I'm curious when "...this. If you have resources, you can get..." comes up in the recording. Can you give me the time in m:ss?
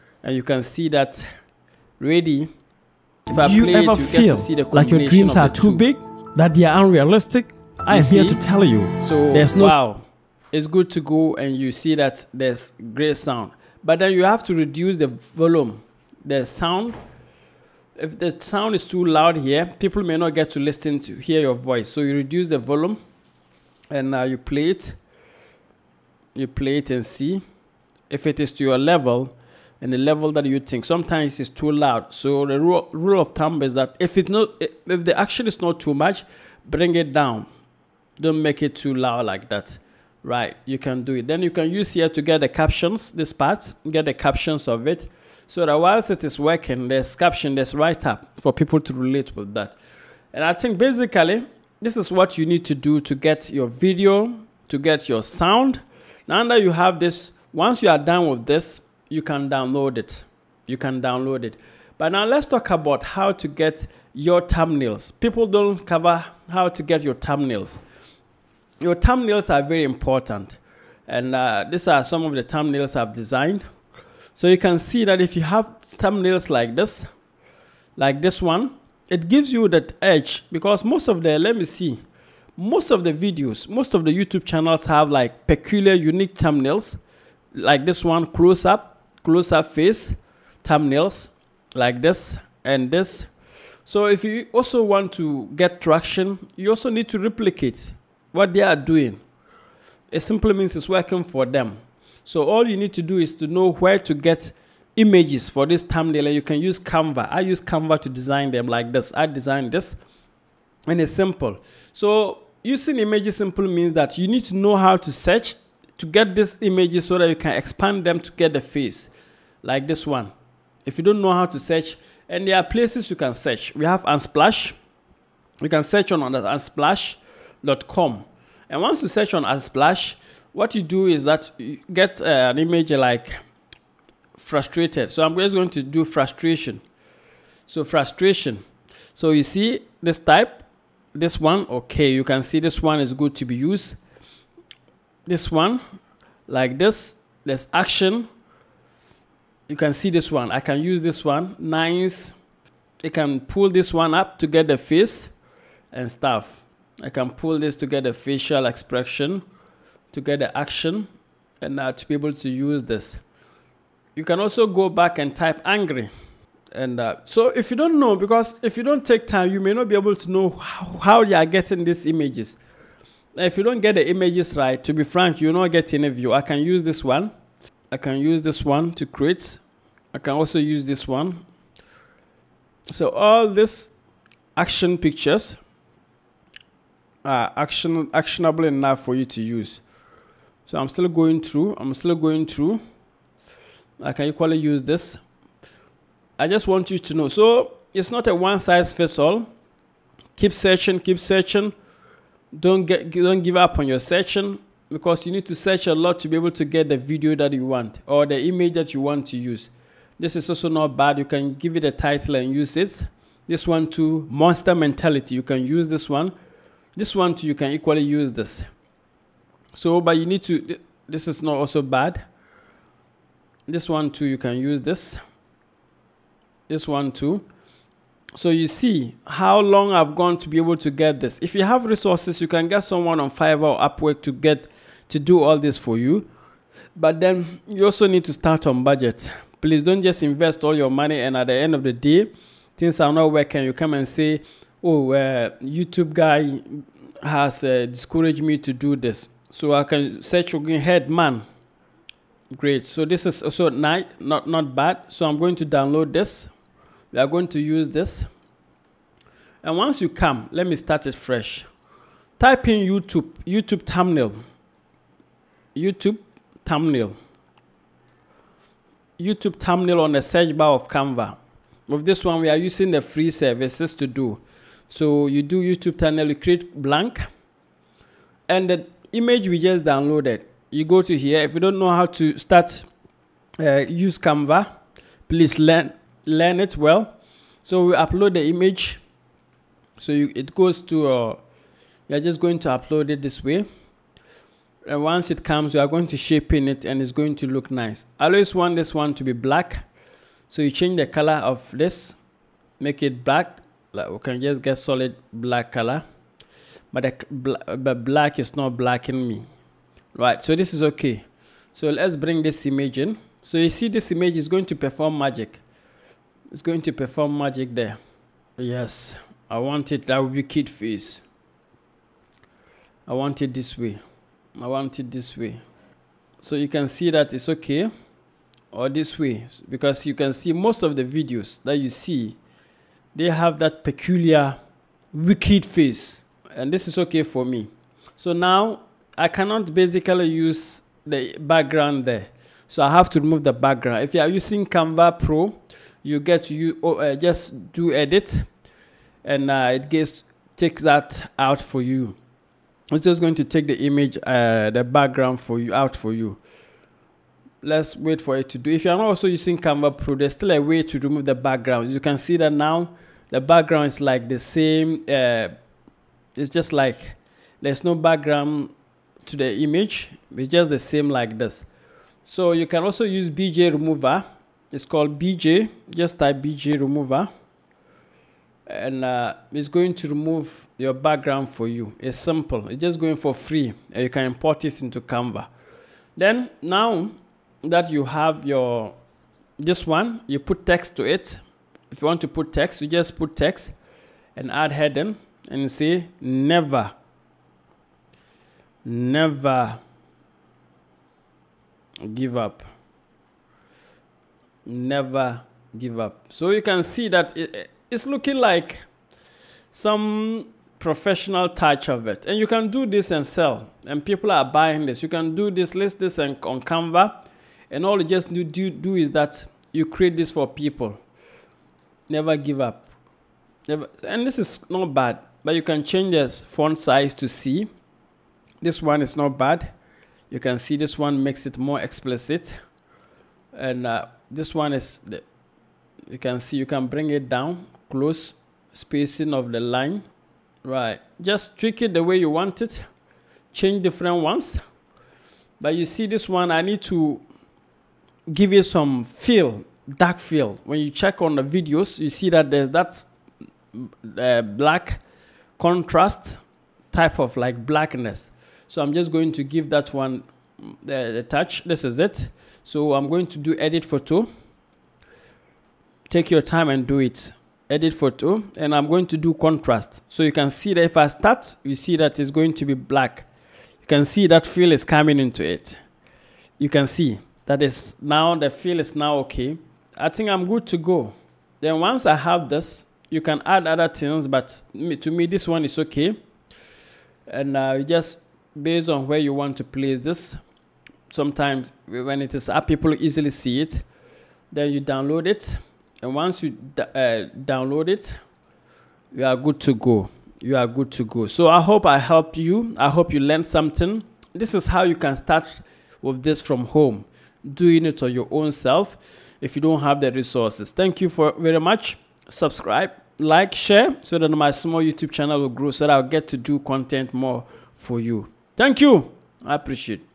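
3:51.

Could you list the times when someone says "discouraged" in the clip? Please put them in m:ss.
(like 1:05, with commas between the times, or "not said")
4:07.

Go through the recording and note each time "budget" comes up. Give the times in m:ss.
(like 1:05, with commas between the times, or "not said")
3:58.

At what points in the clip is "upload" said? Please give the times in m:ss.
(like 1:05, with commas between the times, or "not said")
4:47, 4:52.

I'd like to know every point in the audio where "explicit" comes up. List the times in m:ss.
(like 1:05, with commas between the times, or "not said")
7:11.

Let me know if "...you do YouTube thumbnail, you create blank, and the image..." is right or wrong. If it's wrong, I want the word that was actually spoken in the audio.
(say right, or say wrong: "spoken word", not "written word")
right.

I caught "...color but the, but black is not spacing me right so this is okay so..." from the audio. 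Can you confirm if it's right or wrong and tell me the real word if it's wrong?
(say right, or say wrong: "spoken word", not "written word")
wrong: "blacking", not "spacing".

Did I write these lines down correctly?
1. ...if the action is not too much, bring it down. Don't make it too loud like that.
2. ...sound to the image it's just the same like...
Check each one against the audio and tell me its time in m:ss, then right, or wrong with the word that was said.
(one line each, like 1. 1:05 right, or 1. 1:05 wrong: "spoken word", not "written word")
1. 0:34 right
2. 6:07 wrong: "background", not "sound".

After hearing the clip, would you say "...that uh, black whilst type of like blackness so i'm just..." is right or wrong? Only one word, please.
wrong.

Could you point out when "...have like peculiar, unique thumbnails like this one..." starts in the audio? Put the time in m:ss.
1:24.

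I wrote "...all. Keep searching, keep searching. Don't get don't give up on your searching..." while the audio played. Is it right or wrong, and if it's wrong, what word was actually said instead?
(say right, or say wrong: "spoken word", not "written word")
right.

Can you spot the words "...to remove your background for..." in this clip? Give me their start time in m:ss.
6:19.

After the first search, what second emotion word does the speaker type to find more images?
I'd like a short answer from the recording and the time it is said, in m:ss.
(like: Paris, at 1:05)
angry, at 2:45.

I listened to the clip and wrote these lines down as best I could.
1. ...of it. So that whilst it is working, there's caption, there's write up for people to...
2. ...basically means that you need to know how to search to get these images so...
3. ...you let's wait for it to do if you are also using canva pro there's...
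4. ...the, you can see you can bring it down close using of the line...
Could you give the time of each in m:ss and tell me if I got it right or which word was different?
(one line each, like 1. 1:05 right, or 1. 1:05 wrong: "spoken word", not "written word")
1. 0:44 right
2. 1:53 wrong: "simply", not "basically"
3. 5:56 right
4. 7:15 wrong: "spacing", not "using".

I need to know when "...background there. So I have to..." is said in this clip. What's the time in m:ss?
5:41.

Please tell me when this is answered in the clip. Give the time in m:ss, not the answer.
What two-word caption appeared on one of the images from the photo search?
3:34.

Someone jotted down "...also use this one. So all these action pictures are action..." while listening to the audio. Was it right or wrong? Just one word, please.
right.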